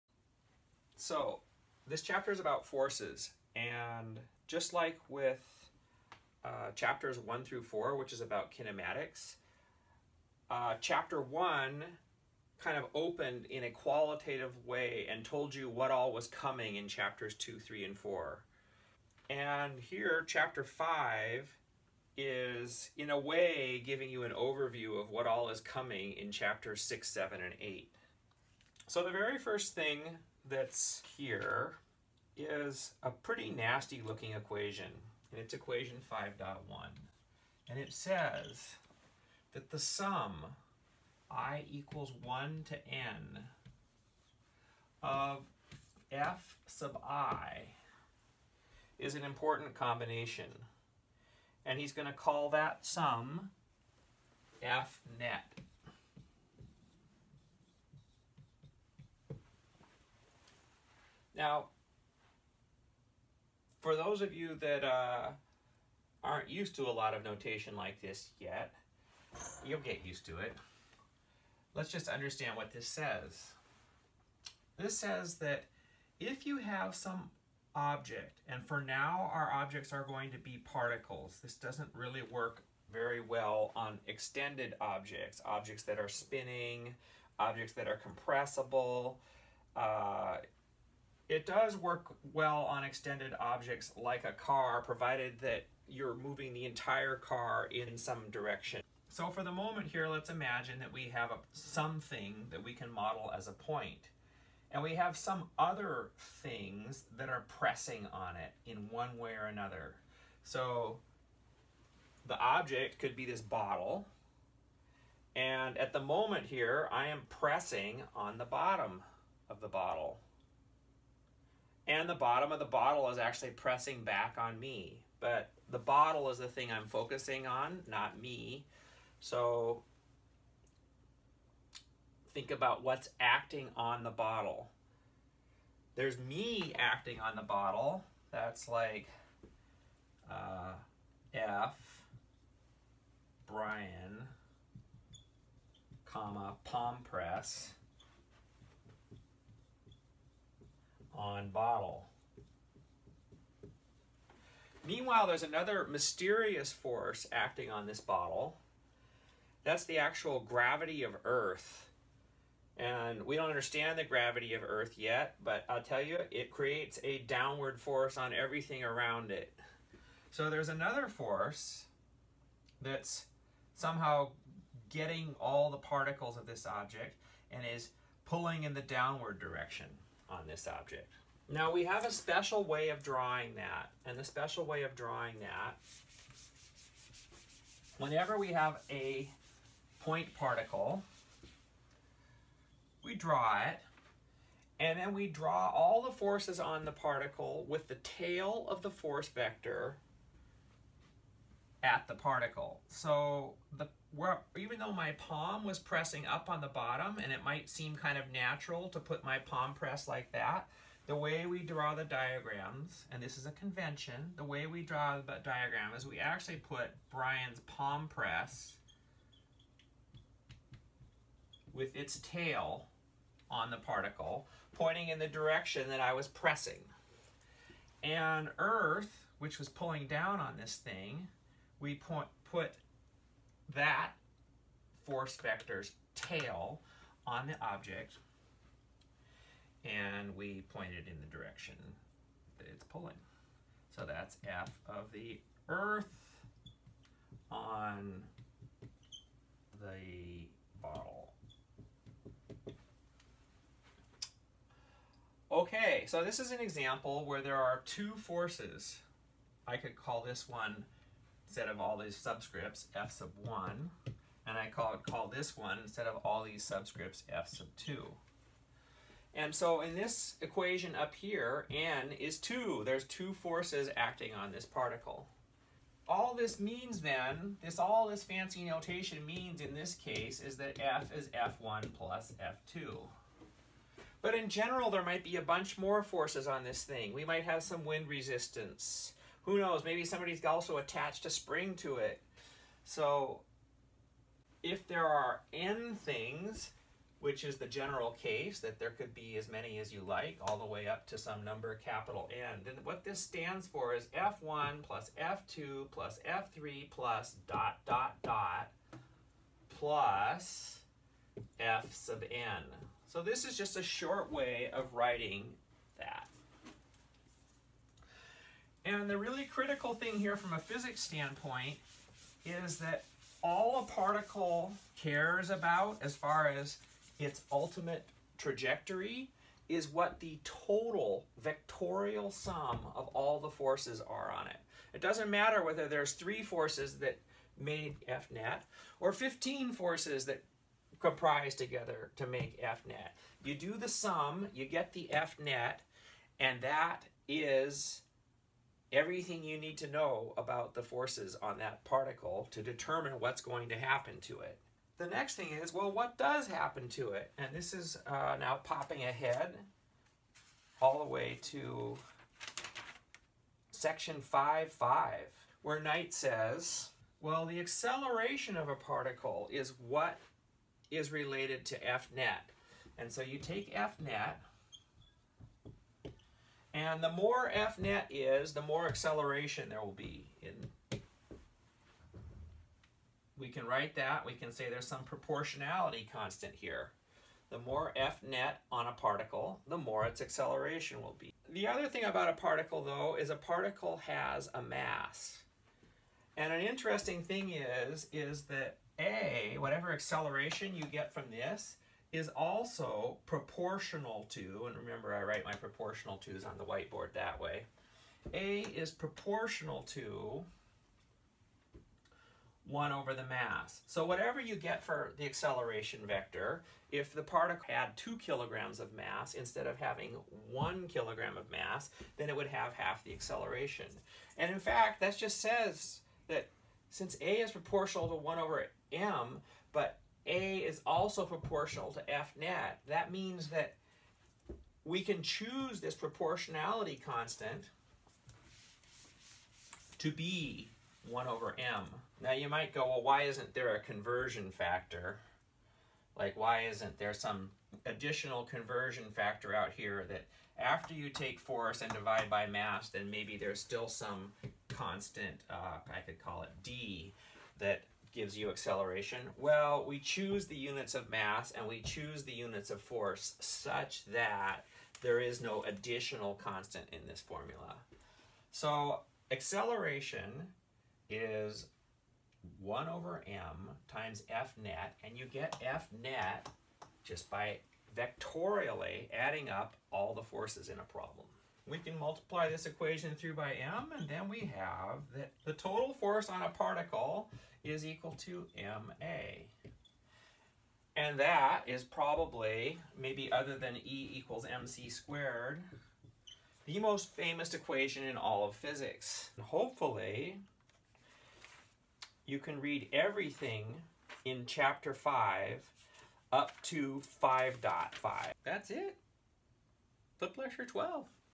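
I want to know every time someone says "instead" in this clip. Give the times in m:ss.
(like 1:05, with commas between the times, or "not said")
4:21, 4:25, 6:59.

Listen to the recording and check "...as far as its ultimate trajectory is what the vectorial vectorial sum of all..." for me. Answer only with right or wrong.
wrong.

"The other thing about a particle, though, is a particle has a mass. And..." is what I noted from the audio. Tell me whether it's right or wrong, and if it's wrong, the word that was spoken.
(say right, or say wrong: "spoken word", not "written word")
right.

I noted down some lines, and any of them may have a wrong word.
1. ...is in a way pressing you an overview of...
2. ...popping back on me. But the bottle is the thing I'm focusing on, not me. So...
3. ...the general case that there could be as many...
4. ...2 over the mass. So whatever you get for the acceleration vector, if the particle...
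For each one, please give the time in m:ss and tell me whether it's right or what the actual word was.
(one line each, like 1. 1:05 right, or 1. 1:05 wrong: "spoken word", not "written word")
1. 0:22 wrong: "giving", not "pressing"
2. 2:03 wrong: "pressing", not "popping"
3. 4:57 right
4. 6:52 wrong: "1", not "2".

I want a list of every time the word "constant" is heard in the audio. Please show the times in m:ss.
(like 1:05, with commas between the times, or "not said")
6:26, 7:17, 7:34, 7:46.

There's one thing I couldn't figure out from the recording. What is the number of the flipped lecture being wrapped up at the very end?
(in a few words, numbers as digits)
12.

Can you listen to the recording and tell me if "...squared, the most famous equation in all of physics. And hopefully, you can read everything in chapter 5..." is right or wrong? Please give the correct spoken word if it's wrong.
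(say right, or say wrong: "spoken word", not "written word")
right.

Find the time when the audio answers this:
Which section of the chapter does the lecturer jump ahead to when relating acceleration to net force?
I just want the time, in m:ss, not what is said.
6:03.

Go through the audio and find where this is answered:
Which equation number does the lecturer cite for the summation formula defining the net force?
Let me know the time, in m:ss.
0:36.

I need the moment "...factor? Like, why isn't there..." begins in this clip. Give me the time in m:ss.
7:24.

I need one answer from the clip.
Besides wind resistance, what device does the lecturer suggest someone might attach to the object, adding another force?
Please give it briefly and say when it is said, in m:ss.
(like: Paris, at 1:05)
spring, at 4:51.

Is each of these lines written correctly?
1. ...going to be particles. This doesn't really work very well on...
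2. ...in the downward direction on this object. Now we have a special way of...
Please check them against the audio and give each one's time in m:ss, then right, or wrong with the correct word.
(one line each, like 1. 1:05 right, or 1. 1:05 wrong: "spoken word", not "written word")
1. 1:20 right
2. 2:58 right.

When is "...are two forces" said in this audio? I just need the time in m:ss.
4:17.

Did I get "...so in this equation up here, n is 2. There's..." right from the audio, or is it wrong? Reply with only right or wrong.
right.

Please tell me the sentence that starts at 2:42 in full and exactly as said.
And we don't understand the gravity of Earth yet, but I'll tell you, it creates a downward force on everything around it.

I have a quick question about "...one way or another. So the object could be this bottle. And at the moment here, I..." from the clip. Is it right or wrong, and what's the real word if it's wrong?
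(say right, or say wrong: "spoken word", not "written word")
right.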